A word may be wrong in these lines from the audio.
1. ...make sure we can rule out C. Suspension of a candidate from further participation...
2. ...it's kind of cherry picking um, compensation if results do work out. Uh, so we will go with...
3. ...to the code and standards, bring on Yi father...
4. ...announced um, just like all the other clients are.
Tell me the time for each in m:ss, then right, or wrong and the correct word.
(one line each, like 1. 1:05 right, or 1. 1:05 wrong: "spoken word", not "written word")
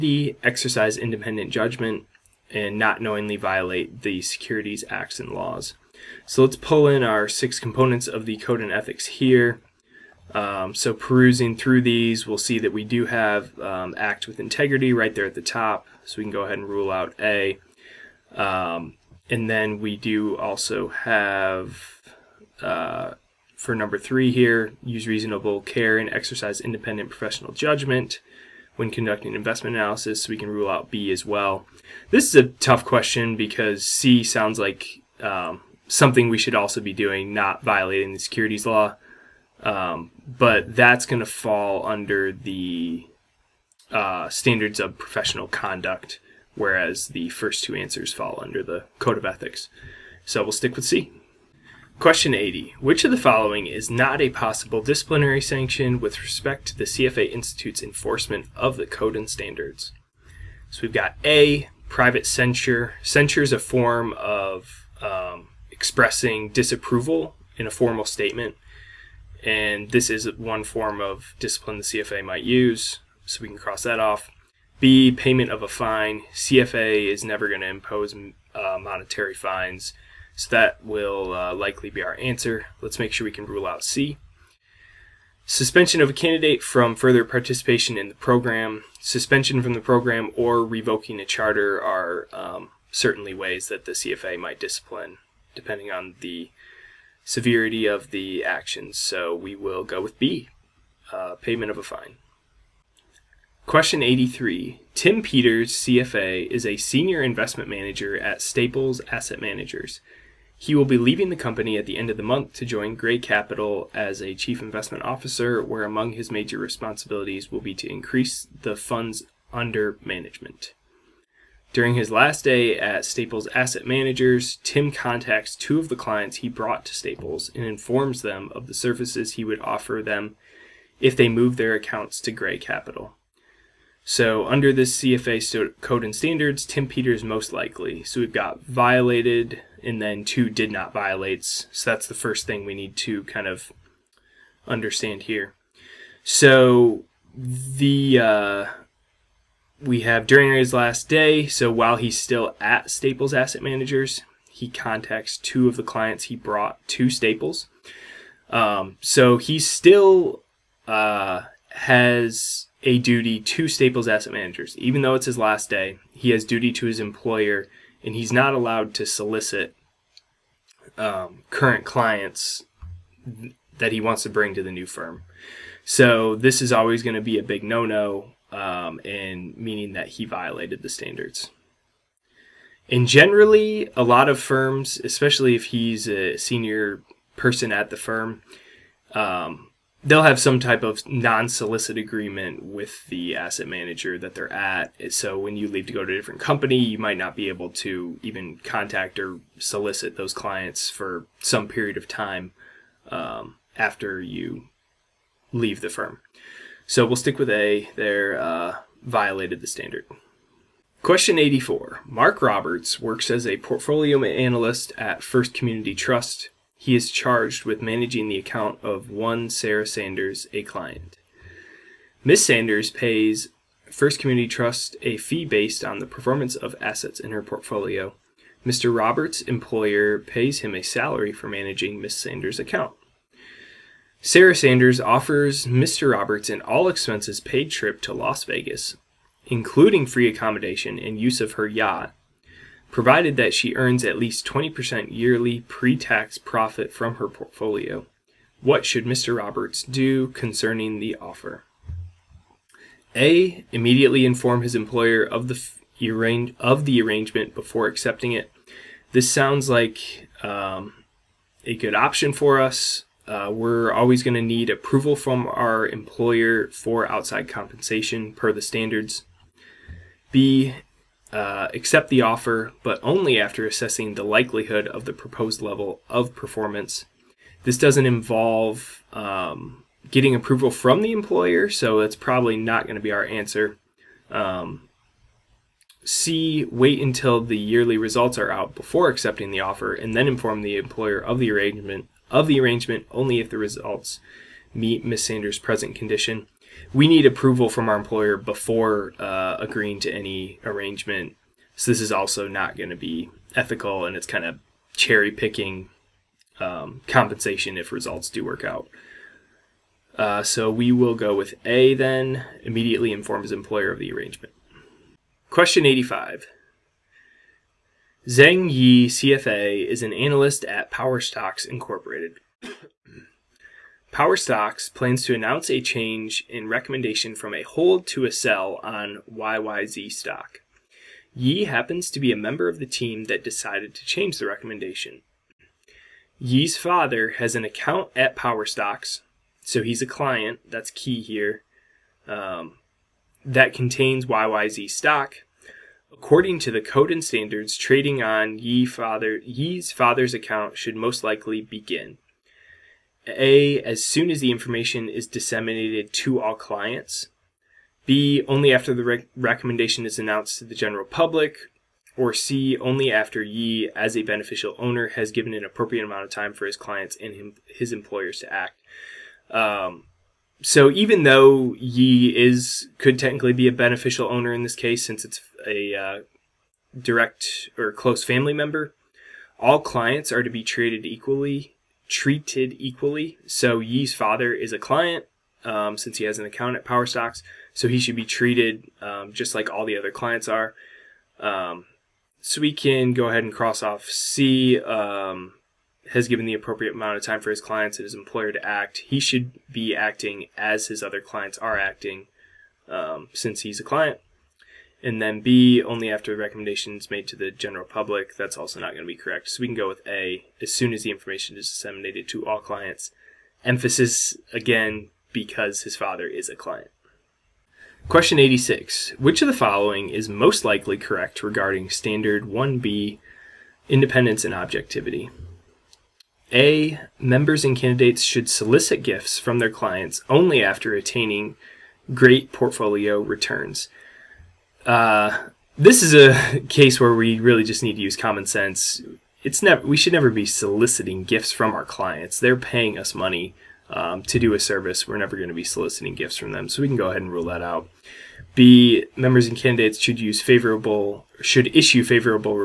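1. 1:22 right
2. 5:04 right
3. 5:46 wrong: "trading", not "bring"
4. 6:28 wrong: "treated", not "announced".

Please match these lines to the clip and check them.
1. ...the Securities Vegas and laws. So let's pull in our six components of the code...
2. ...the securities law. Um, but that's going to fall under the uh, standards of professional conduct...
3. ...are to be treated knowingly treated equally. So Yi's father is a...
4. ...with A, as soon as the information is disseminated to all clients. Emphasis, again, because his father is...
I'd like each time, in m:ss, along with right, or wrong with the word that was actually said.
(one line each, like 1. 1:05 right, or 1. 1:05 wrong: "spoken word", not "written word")
1. 0:04 wrong: "Acts", not "Vegas"
2. 0:38 right
3. 6:20 wrong: "equally", not "knowingly"
4. 6:49 right.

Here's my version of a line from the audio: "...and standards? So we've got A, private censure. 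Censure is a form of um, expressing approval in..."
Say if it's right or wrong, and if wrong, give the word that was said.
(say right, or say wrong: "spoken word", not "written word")
wrong: "disapproval", not "approval".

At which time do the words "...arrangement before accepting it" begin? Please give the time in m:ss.
4:17.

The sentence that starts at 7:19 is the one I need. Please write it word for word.
It's never we should never be soliciting gifts from our clients.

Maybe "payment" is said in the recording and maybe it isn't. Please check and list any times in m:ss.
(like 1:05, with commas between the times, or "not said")
1:15, 1:41.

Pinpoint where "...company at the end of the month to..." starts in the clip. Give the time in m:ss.
1:51.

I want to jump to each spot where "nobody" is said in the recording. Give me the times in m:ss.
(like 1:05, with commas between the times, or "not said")
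not said.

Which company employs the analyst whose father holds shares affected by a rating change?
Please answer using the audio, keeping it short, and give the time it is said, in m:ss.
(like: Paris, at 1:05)
Power Stocks Incorporated, at 5:20.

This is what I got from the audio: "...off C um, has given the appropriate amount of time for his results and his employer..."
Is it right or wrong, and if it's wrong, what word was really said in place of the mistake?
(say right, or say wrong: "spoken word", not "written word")
wrong: "clients", not "results".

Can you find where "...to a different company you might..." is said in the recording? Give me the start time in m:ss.
3:16.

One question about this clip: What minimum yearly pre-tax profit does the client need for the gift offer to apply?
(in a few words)
20%.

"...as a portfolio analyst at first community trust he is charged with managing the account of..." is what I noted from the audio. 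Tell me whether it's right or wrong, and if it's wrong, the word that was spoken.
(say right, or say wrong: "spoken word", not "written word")
right.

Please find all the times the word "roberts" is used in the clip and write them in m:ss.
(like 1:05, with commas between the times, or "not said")
3:32, 3:48, 3:56, 4:09.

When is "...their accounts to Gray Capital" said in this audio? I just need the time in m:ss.
2:11.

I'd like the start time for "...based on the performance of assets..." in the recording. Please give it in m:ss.
3:45.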